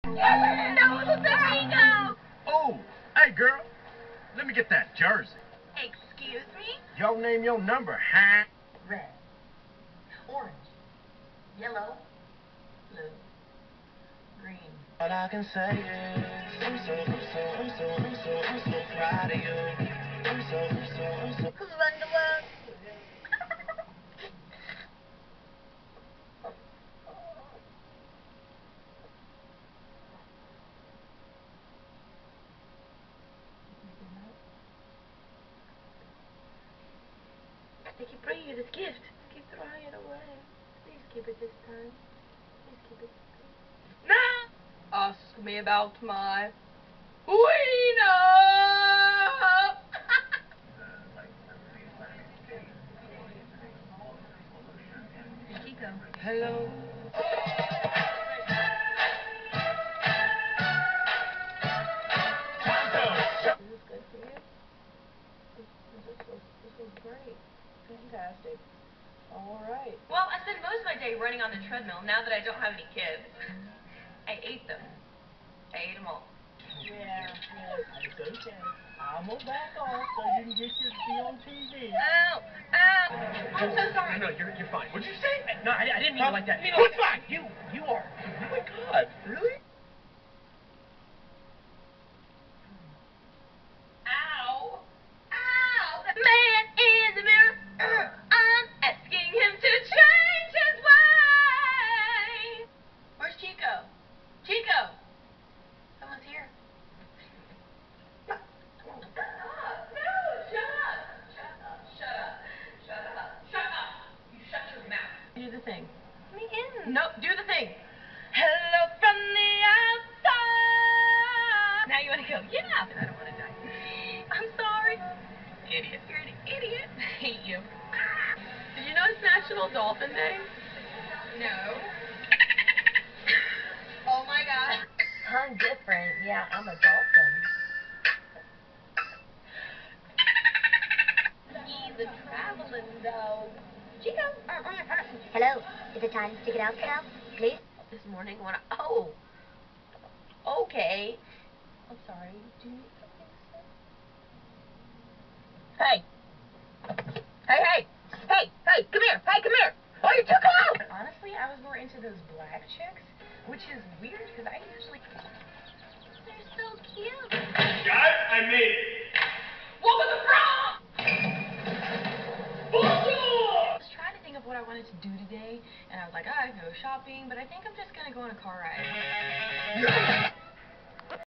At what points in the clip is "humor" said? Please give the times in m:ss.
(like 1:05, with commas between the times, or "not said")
not said.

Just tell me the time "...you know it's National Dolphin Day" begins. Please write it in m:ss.
2:08.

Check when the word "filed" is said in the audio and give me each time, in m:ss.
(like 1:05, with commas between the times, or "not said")
not said.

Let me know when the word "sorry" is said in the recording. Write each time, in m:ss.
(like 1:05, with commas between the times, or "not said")
1:23, 2:04, 2:32.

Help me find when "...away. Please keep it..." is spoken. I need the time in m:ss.
0:39.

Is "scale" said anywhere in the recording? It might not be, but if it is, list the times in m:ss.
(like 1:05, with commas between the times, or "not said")
not said.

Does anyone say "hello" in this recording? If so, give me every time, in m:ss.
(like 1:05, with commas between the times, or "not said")
0:56, 1:58, 2:25.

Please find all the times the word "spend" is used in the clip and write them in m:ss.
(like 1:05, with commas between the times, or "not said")
1:10.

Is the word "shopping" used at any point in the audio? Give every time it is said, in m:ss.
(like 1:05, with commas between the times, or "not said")
2:56.